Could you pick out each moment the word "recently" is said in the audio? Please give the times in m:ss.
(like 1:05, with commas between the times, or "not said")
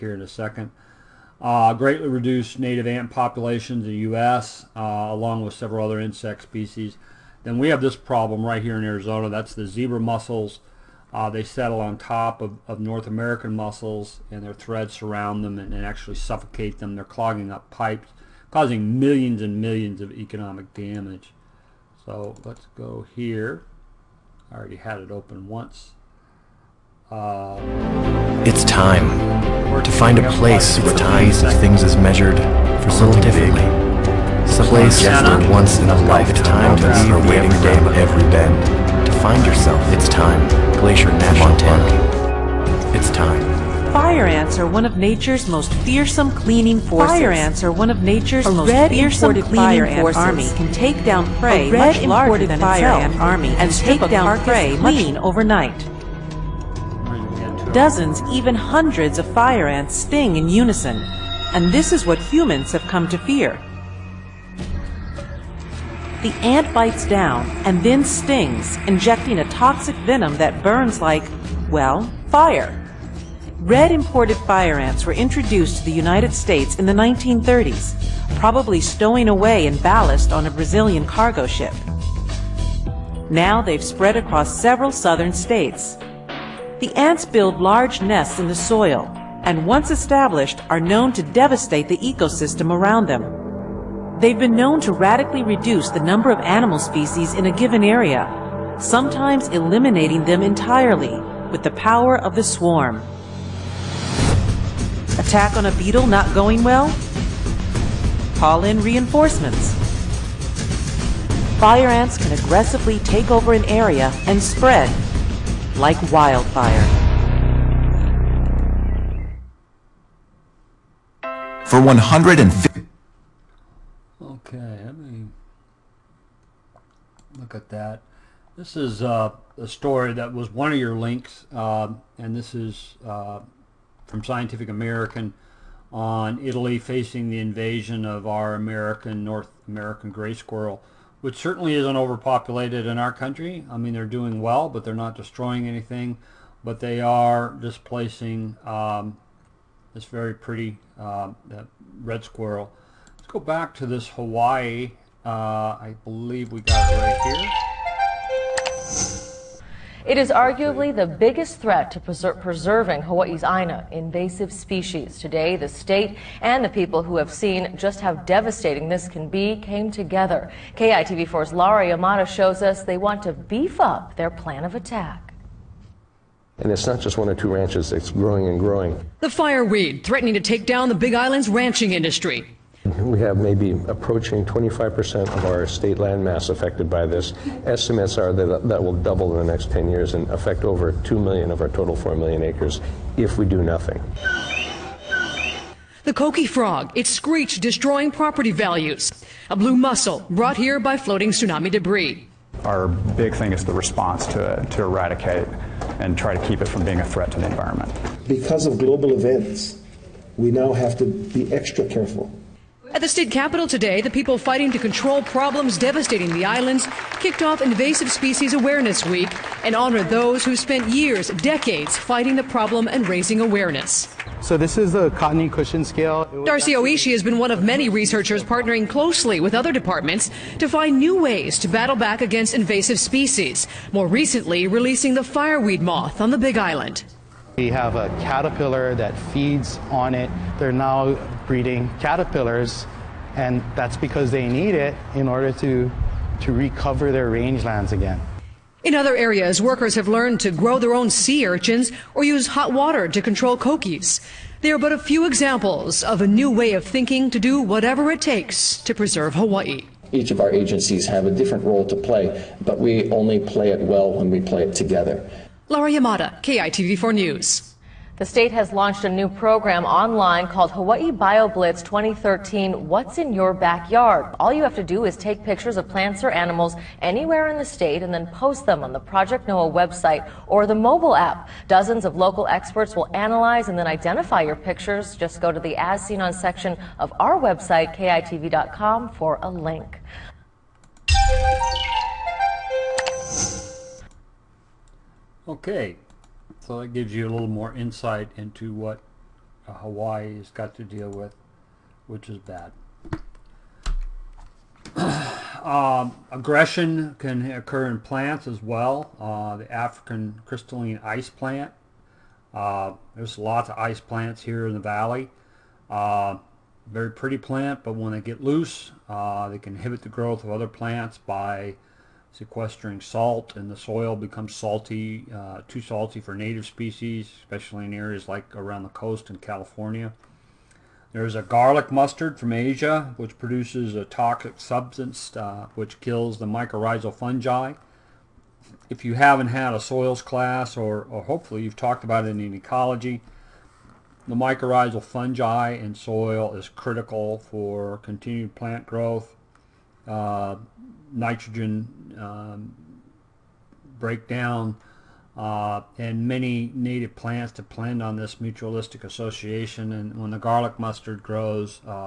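3:54.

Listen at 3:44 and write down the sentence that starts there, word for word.
So this is the cottony cushion scale.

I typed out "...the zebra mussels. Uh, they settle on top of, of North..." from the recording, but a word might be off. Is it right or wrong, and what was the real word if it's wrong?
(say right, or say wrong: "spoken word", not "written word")
right.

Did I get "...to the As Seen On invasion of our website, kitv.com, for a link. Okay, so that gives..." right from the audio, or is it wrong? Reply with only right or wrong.
wrong.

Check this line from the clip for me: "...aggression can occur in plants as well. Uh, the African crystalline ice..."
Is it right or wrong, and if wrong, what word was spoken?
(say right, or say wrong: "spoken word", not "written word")
right.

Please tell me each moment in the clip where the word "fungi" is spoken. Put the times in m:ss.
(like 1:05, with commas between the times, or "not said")
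5:37, 5:45.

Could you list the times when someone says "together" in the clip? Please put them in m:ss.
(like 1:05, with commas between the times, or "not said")
2:49, 4:24.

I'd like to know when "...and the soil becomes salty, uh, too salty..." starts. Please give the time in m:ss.
5:23.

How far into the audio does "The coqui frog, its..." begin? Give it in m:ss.
3:16.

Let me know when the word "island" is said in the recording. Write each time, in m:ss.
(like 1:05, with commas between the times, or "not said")
3:01, 3:36, 3:56.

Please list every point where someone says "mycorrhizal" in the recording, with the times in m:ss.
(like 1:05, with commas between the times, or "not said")
5:36, 5:44.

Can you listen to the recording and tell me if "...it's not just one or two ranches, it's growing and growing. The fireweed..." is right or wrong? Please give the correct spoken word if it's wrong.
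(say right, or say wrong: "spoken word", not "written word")
right.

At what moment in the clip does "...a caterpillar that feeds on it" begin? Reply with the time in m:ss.
3:57.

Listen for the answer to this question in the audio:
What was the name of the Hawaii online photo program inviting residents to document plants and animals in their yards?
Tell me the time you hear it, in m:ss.
4:30.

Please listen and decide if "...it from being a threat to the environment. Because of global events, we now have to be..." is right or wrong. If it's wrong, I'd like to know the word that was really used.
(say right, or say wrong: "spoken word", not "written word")
right.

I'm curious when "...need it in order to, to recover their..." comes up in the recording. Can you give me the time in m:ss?
4:04.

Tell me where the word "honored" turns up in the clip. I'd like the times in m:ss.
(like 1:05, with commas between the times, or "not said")
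3:39.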